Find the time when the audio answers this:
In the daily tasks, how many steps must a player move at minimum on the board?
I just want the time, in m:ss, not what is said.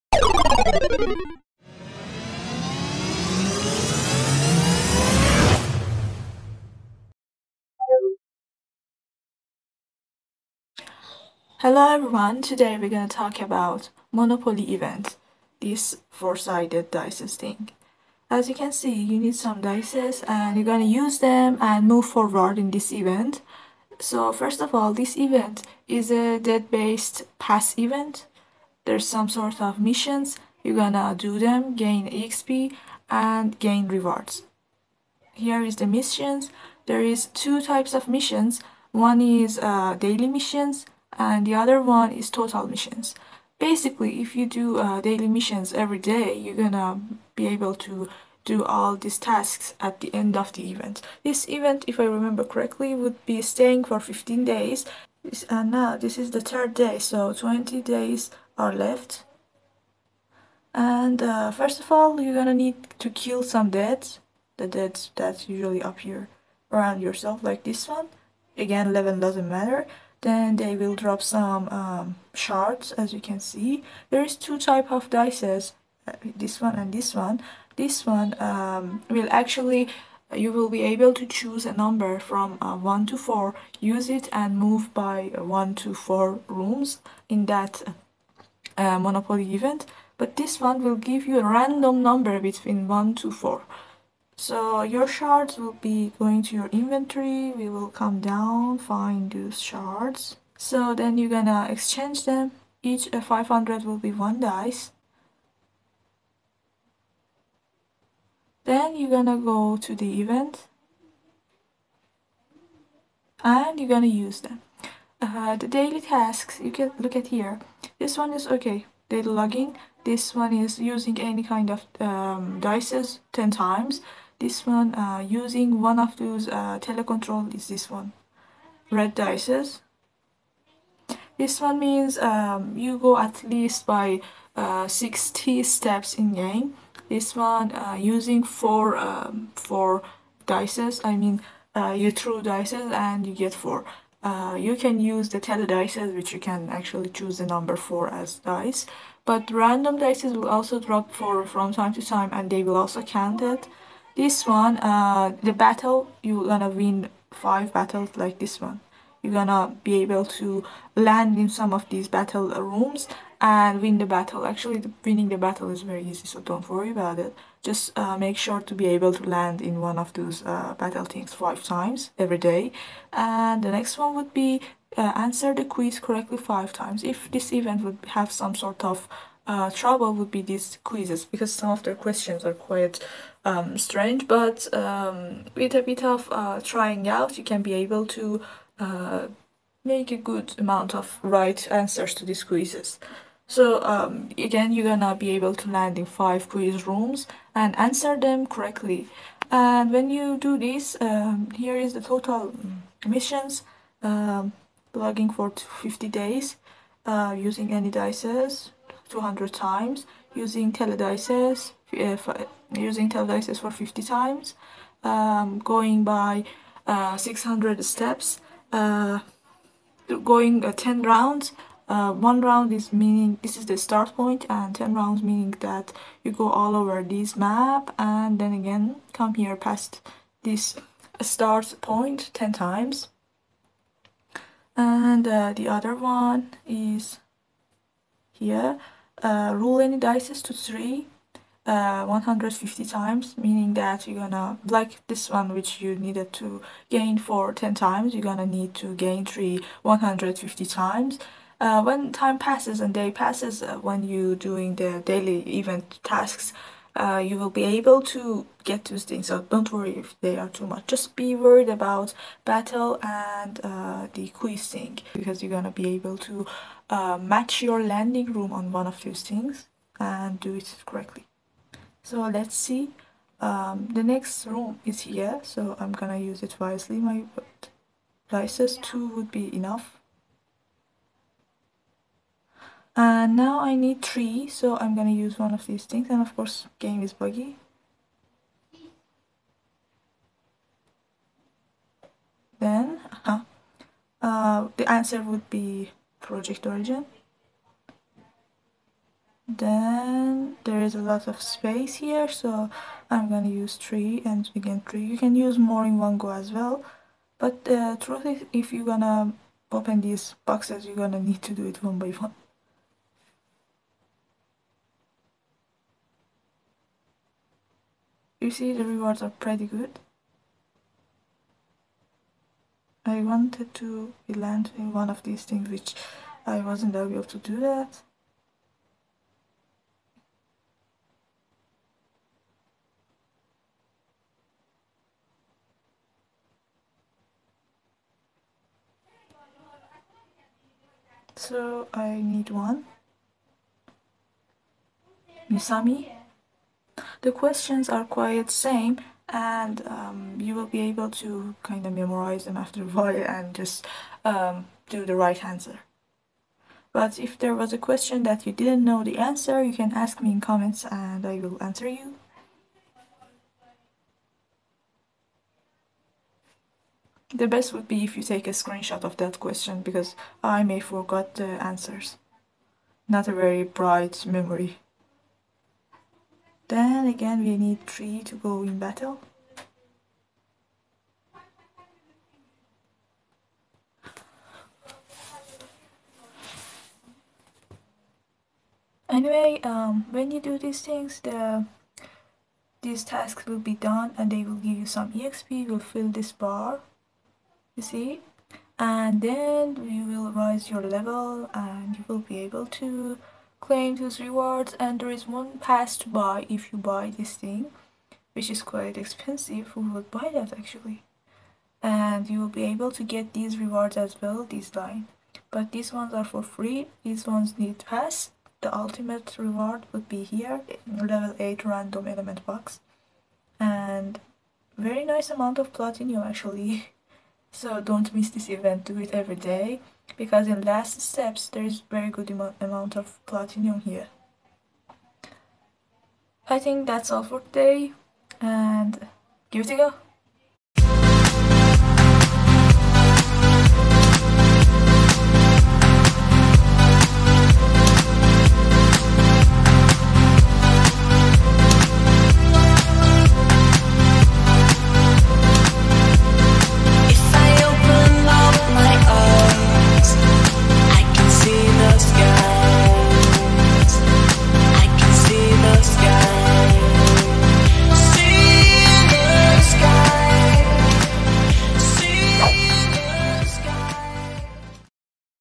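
2:14.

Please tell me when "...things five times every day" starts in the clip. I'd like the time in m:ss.
2:51.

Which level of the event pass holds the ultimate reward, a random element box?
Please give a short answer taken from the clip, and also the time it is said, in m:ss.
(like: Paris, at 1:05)
8, at 7:00.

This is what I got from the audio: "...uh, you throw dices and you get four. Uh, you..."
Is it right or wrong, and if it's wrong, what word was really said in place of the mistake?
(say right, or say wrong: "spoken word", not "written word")
right.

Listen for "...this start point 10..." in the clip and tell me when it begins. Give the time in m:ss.
3:50.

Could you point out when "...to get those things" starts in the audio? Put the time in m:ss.
4:18.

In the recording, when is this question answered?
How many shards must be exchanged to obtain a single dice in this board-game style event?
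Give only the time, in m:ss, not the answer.
1:43.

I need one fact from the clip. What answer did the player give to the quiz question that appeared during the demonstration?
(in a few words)
Project Origin.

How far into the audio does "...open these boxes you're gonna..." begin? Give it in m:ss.
5:09.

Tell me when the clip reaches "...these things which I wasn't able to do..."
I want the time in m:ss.
5:25.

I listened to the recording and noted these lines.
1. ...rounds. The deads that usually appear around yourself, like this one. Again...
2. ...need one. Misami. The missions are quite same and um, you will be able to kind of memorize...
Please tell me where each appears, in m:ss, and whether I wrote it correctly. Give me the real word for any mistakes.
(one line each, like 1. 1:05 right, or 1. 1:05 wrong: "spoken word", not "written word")
1. 1:03 wrong: "deads", not "rounds"
2. 5:42 wrong: "questions", not "missions".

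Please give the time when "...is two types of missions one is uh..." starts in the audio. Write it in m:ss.
0:37.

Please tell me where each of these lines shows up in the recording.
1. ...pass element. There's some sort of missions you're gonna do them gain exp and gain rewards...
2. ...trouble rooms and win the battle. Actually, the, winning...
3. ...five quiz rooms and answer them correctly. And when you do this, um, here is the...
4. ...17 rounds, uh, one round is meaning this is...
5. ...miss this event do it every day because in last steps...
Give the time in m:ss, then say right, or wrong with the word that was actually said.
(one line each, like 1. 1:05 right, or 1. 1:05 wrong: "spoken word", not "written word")
1. 0:27 wrong: "event", not "element"
2. 2:42 wrong: "battle", not "trouble"
3. 3:16 right
4. 3:40 wrong: "10", not "17"
5. 7:08 right.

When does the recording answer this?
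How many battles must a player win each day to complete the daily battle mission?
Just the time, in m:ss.
2:36.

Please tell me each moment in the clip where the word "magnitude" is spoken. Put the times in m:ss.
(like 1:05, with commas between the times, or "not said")
not said.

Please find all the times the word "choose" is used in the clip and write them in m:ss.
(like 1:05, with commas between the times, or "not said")
1:21, 2:27.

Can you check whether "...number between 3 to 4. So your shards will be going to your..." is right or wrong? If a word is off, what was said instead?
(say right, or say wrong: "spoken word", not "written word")
wrong: "1", not "3".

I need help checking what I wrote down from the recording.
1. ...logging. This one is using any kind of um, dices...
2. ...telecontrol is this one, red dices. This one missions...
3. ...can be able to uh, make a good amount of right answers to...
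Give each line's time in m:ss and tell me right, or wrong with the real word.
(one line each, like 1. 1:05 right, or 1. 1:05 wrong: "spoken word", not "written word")
1. 1:59 right
2. 2:06 wrong: "means", not "missions"
3. 3:07 right.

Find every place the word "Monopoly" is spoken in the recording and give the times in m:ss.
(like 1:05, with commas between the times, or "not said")
0:14, 1:28.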